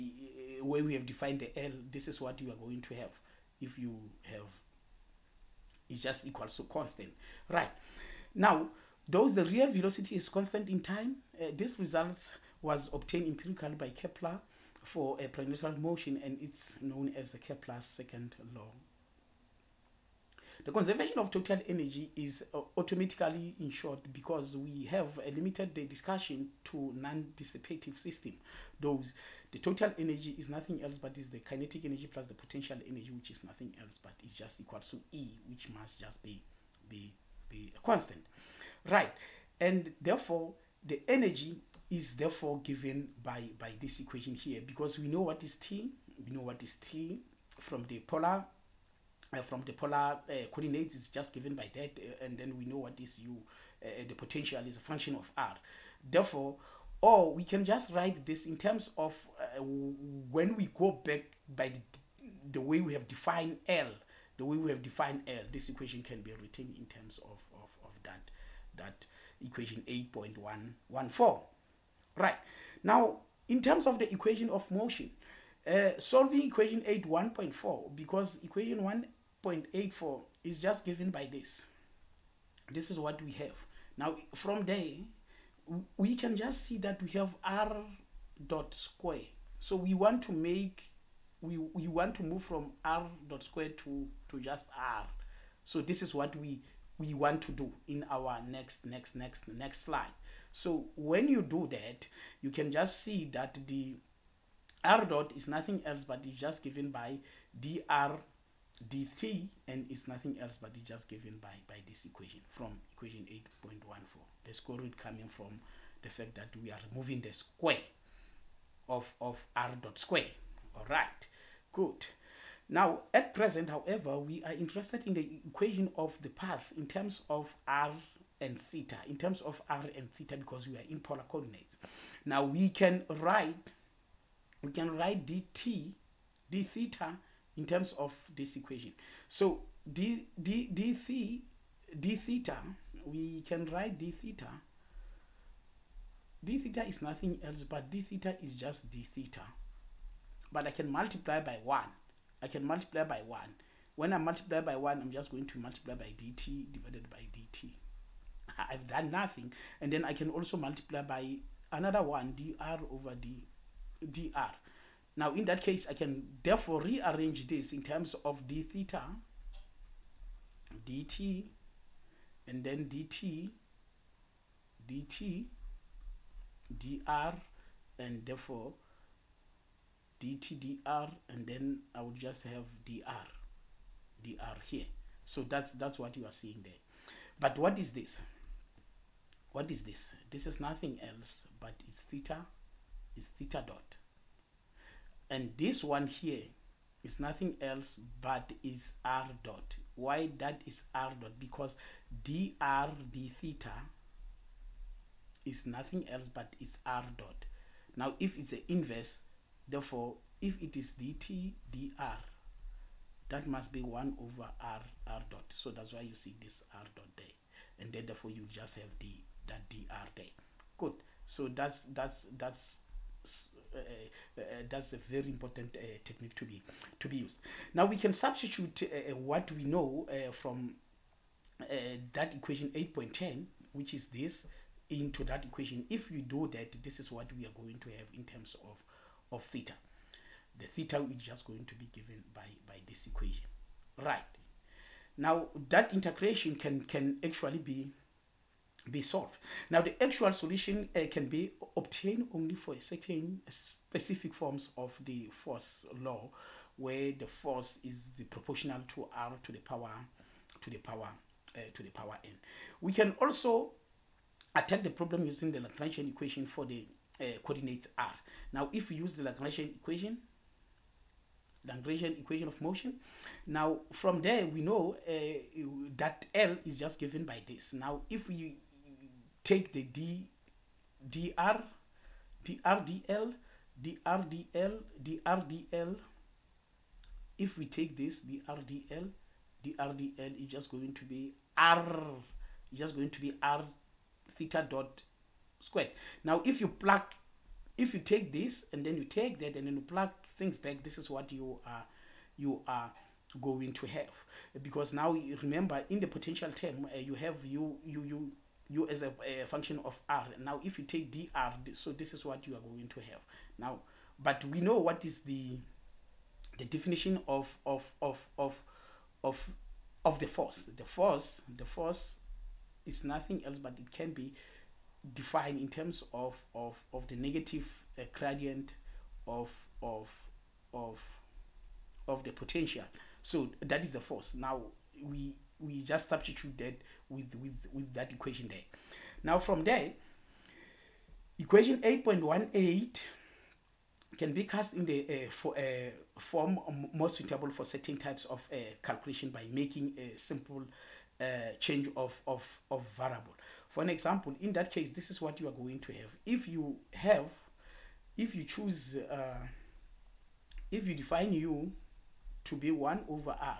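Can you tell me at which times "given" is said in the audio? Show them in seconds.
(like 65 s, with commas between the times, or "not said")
42 s, 51 s, 80 s, 106 s, 111 s, 241 s, 276 s.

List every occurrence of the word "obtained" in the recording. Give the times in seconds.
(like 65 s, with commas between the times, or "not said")
12 s, 251 s.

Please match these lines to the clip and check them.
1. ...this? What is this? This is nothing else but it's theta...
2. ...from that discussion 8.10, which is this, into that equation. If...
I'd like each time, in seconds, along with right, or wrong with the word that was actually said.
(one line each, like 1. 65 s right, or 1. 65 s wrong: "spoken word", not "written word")
1. 187 s right
2. 230 s wrong: "equation", not "discussion".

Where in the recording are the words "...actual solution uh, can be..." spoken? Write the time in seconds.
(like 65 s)
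250 s.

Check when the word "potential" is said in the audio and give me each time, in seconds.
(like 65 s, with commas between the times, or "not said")
32 s, 54 s, 306 s, 332 s.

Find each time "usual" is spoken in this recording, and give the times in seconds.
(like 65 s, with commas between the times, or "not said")
not said.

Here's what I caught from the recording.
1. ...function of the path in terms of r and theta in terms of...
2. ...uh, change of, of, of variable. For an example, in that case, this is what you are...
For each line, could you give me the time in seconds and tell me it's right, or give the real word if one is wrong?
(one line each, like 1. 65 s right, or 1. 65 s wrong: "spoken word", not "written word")
1. 125 s wrong: "equation", not "function"
2. 351 s right.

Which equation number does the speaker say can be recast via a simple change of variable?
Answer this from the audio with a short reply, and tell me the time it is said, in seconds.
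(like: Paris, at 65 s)
8.18, at 341 s.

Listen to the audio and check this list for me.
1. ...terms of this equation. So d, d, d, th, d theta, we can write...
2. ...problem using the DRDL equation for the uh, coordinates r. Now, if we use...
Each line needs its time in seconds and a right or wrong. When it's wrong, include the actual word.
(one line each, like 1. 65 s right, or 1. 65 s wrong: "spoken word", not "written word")
1. 137 s right
2. 264 s wrong: "Lagrangian", not "DRDL".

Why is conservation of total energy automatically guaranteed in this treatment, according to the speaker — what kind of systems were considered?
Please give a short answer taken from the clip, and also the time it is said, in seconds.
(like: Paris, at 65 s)
non-dissipative system, at 26 s.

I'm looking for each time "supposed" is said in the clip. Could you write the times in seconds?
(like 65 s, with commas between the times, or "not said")
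not said.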